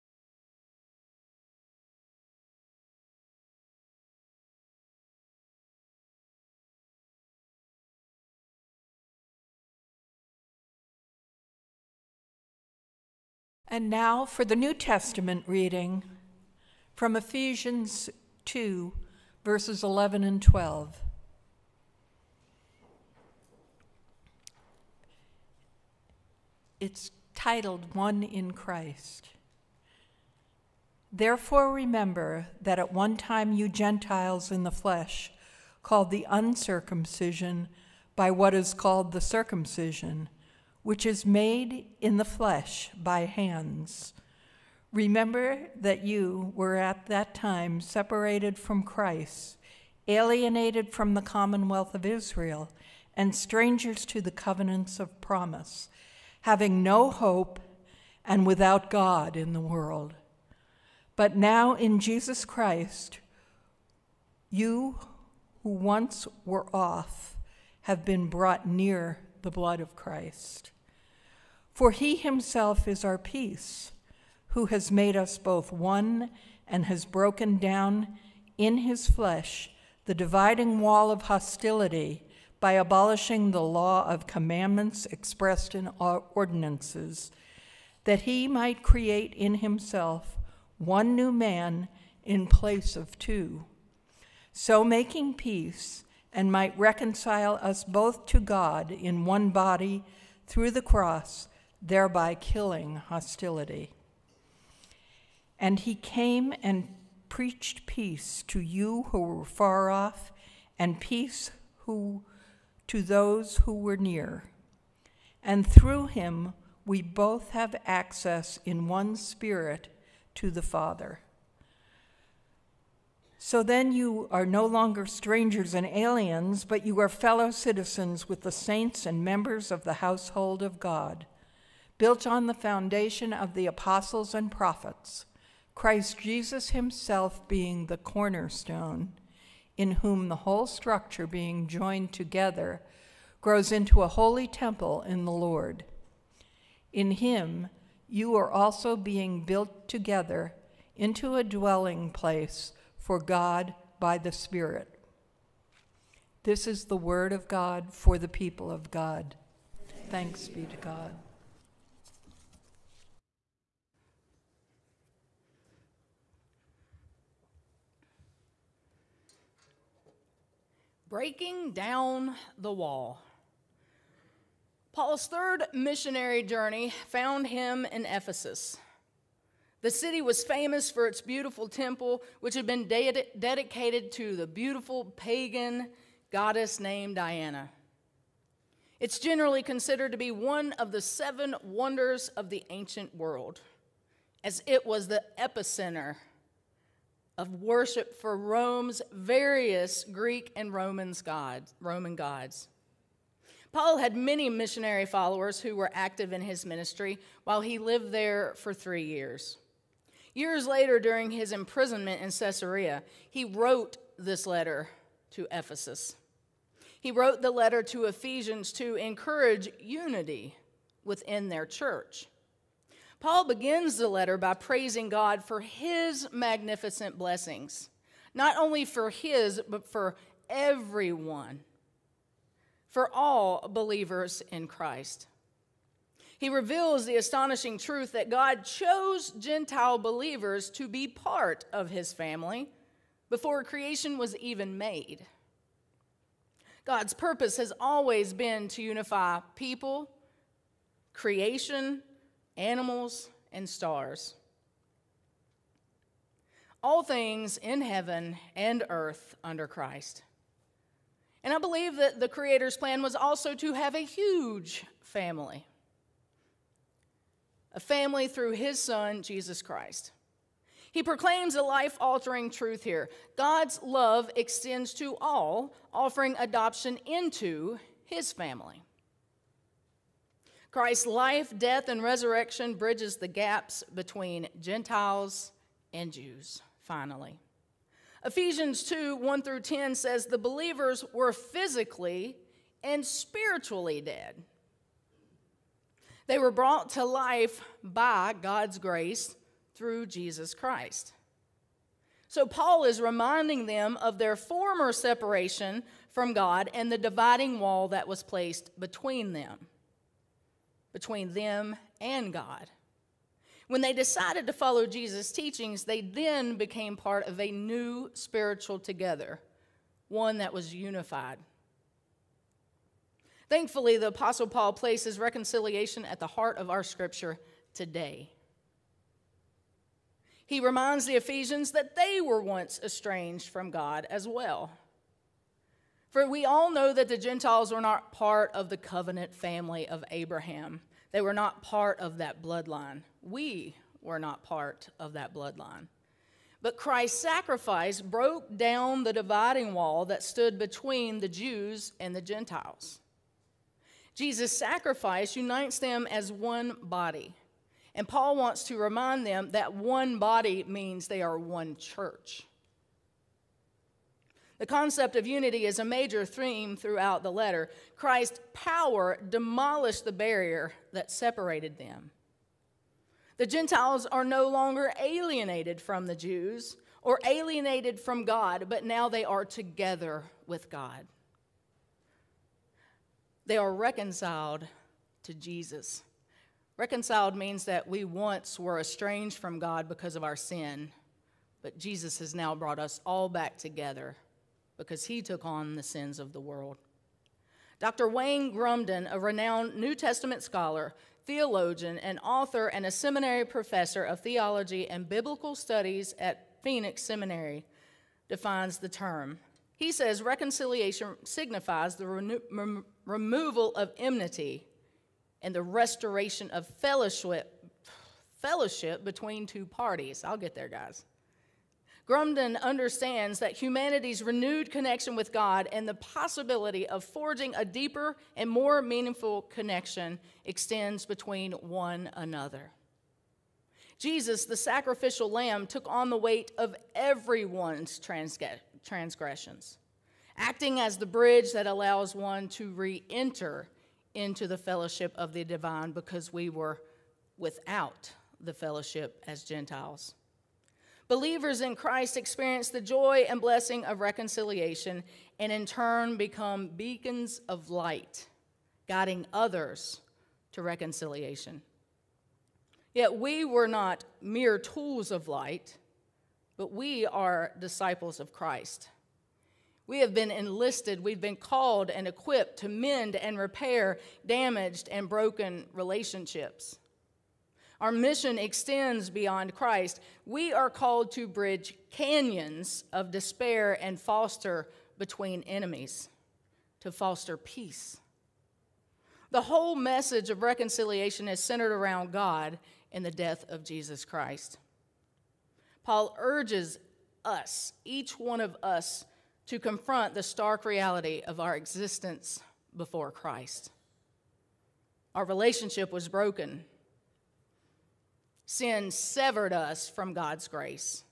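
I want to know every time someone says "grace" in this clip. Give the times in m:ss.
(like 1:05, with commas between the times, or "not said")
4:58, 8:30.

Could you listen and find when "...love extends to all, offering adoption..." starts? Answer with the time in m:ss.
4:33.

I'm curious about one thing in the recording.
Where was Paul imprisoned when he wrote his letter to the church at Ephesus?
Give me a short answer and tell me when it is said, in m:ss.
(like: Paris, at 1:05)
Caesarea, at 3:32.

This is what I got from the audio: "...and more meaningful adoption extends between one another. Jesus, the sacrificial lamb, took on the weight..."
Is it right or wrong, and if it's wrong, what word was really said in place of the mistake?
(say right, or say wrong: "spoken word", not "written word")
wrong: "connection", not "adoption".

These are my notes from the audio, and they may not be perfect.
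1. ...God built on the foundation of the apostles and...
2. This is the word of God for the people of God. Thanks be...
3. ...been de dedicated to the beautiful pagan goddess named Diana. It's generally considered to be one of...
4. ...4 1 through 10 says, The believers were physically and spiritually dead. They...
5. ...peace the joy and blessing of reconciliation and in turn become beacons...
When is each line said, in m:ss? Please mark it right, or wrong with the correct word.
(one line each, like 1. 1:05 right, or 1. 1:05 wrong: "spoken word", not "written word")
1. 2:10 right
2. 2:36 right
3. 3:02 right
4. 4:48 wrong: "2", not "4"
5. 7:32 wrong: "experience", not "peace".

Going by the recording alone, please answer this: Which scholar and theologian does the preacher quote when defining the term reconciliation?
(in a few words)
Wayne Grudem.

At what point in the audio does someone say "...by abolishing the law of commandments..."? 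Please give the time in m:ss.
1:22.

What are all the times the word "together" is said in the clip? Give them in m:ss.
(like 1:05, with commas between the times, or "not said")
2:22, 2:29, 5:18, 6:19, 6:33.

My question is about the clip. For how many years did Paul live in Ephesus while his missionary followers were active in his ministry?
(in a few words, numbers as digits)
3.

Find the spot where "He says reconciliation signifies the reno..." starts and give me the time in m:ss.
6:49.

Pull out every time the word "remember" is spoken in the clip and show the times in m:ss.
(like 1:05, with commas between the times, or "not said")
0:31, 0:44.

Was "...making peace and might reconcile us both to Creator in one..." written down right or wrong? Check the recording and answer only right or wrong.
wrong.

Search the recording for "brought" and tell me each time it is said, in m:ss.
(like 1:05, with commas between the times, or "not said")
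1:08, 4:56, 6:32.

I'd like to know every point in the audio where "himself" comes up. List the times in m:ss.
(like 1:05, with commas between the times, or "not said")
1:12, 1:29, 2:16.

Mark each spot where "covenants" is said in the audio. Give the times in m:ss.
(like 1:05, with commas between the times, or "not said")
0:54, 5:38.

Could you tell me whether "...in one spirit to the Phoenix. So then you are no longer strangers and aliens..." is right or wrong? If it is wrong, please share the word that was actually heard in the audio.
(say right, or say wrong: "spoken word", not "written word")
wrong: "Father", not "Phoenix".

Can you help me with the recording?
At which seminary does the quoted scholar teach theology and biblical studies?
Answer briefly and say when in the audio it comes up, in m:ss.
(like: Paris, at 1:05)
Phoenix Seminary, at 6:46.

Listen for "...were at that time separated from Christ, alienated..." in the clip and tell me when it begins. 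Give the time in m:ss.
0:46.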